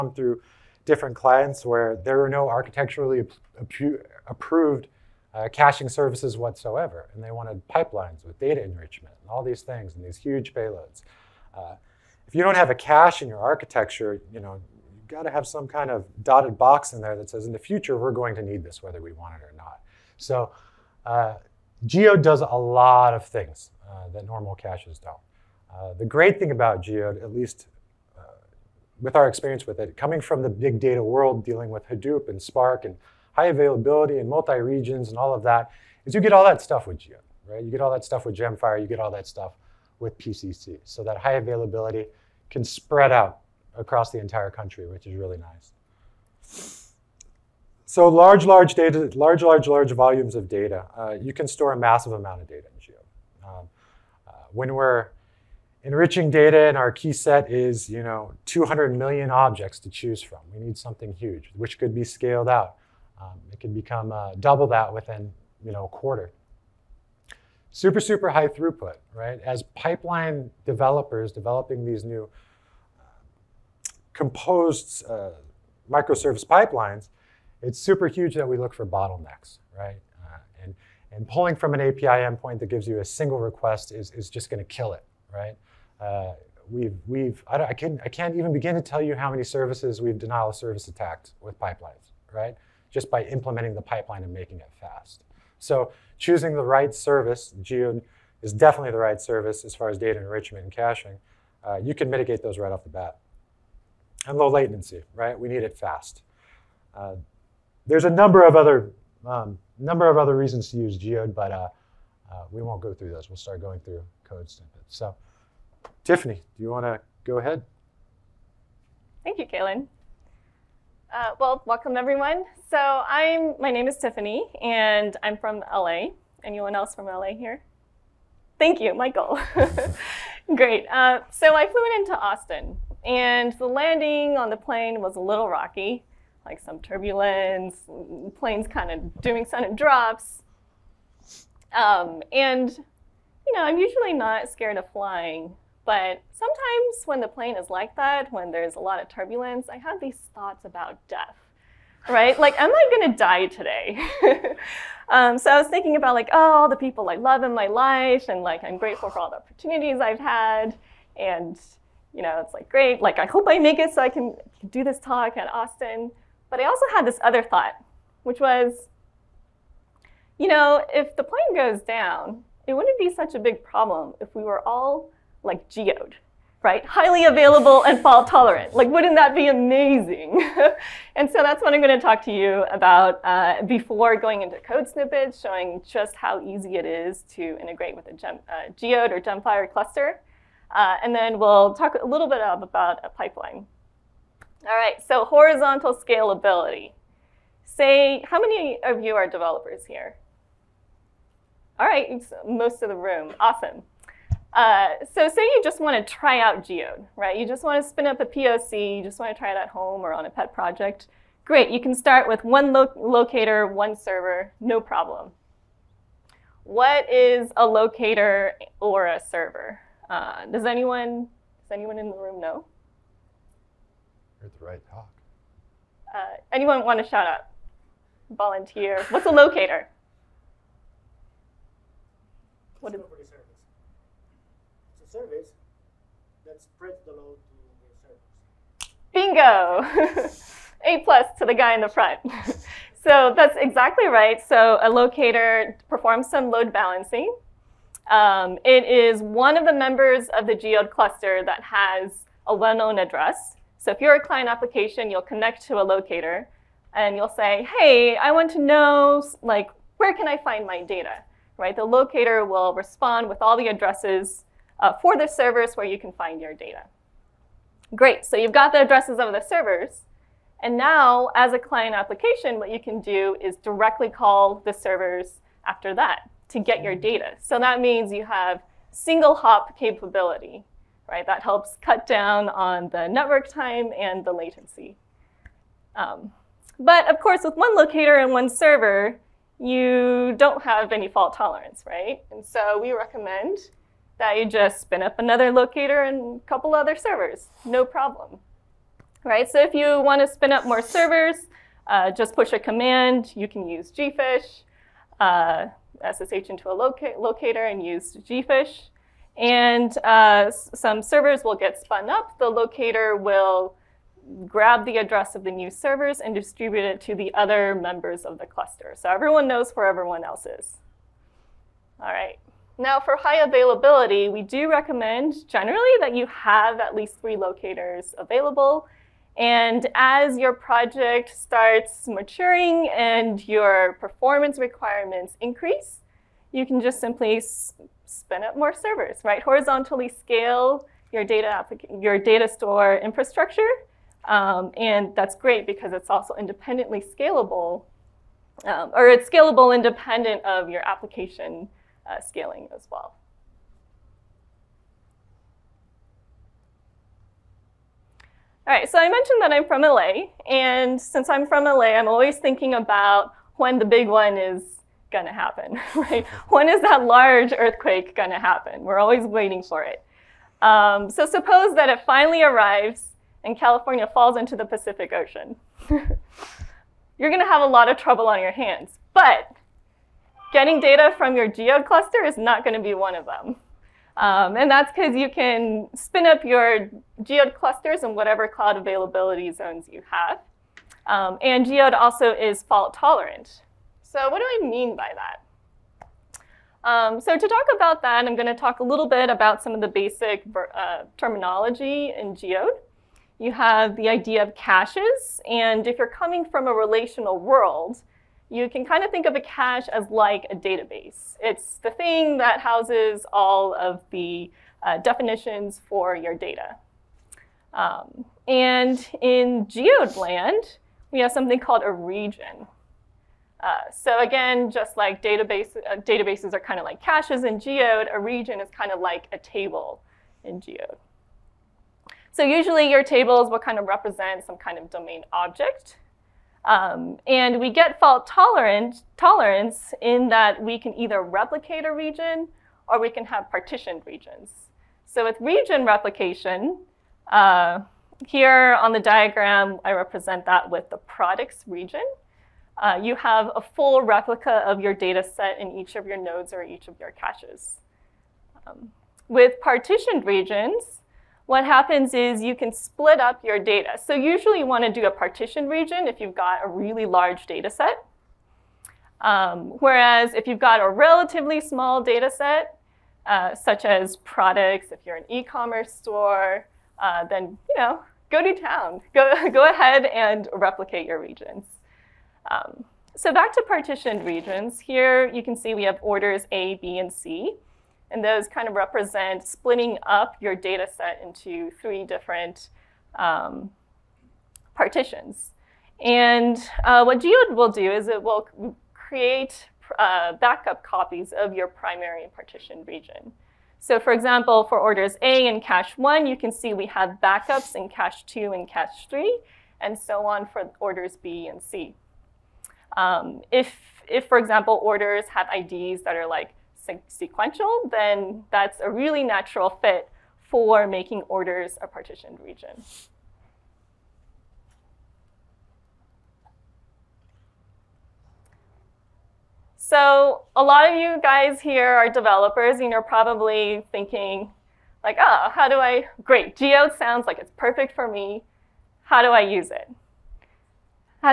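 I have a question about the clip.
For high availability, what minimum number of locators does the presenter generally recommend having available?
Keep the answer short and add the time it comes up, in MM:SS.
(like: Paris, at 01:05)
3, at 05:27.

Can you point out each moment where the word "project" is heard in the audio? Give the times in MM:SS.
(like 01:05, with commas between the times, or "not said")
03:30, 05:30.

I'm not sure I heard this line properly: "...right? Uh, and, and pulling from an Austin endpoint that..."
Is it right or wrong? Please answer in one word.
wrong.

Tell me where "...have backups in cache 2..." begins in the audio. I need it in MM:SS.
08:26.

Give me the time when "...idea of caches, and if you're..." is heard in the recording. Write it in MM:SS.
06:44.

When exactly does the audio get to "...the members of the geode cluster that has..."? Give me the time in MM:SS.
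04:09.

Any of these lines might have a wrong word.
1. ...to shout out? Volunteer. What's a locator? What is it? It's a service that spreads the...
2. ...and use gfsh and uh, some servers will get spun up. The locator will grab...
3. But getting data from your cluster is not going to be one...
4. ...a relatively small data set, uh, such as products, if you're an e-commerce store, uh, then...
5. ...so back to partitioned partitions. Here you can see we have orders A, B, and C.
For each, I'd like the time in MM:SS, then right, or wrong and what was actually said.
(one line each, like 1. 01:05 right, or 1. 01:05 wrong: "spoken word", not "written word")
1. 03:47 right
2. 05:07 right
3. 06:19 right
4. 07:50 right
5. 08:03 wrong: "regions", not "partitions".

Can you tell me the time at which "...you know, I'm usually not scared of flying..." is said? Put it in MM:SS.
02:22.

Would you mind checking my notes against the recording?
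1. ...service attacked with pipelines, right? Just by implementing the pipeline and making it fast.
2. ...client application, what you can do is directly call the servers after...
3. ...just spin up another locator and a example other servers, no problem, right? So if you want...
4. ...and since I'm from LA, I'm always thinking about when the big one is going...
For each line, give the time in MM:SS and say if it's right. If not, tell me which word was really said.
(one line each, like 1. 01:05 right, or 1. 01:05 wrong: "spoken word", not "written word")
1. 01:30 right
2. 04:31 right
3. 04:54 wrong: "couple", not "example"
4. 06:00 right.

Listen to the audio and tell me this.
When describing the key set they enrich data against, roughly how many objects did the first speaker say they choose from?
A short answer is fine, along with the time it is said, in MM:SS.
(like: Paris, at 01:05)
200 million, at 00:58.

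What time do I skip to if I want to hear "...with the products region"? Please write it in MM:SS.
07:30.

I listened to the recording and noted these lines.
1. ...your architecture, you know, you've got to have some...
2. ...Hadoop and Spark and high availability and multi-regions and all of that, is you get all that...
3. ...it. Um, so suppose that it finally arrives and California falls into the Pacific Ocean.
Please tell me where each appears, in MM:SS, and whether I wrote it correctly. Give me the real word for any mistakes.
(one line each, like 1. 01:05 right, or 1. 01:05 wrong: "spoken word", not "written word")
1. 00:13 right
2. 00:31 right
3. 06:09 right.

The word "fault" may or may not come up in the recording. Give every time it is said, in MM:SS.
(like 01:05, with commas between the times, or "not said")
02:58, 04:51, 06:32, 07:17.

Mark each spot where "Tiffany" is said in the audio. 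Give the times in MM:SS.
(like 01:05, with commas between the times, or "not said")
01:56, 02:03.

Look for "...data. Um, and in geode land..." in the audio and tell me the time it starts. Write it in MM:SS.
06:56.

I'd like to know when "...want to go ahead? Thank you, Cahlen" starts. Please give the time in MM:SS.
01:56.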